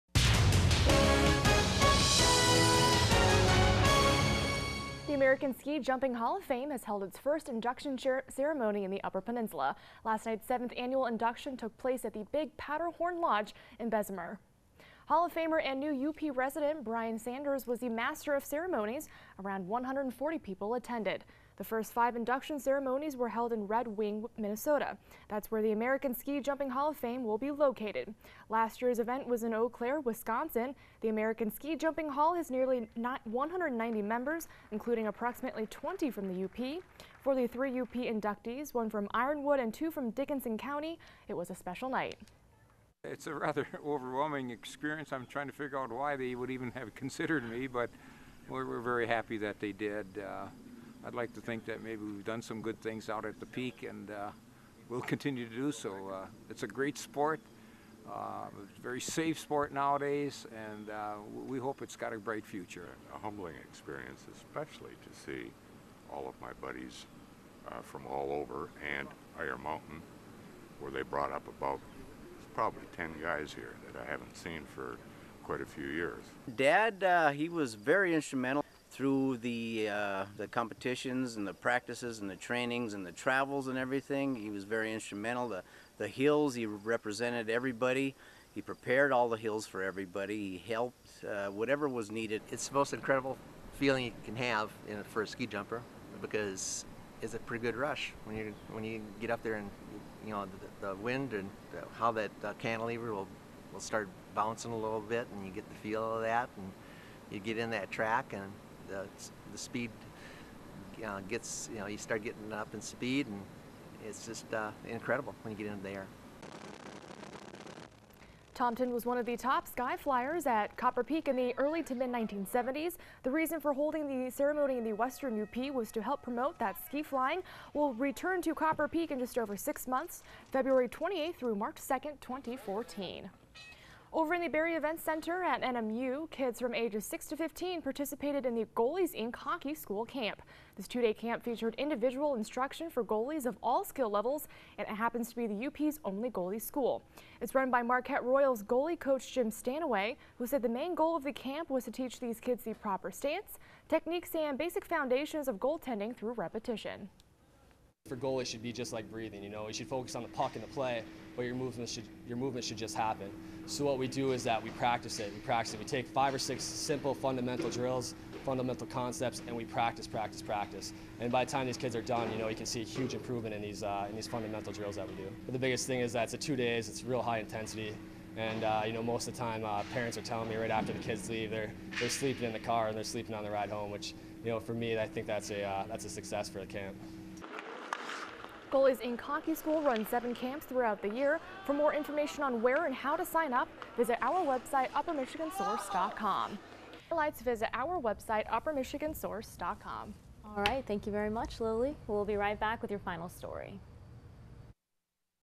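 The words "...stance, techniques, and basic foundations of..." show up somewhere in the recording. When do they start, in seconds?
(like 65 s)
153 s.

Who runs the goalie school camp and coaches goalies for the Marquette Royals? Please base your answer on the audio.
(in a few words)
Jim Stanaway.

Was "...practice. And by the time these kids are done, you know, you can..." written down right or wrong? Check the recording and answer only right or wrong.
right.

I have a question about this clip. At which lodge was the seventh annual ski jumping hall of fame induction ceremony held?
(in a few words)
Big Powderhorn Lodge.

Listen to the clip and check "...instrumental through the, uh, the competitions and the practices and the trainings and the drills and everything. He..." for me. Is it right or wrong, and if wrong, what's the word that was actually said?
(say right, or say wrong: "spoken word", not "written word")
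wrong: "travels", not "drills".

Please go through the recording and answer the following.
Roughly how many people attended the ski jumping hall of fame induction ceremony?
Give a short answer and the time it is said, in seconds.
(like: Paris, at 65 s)
140, at 19 s.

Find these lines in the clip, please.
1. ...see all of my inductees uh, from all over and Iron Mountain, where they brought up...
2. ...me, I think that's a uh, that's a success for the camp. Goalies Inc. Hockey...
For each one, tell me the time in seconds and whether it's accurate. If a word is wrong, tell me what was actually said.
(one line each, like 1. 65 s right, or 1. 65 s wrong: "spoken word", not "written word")
1. 65 s wrong: "buddies", not "inductees"
2. 184 s right.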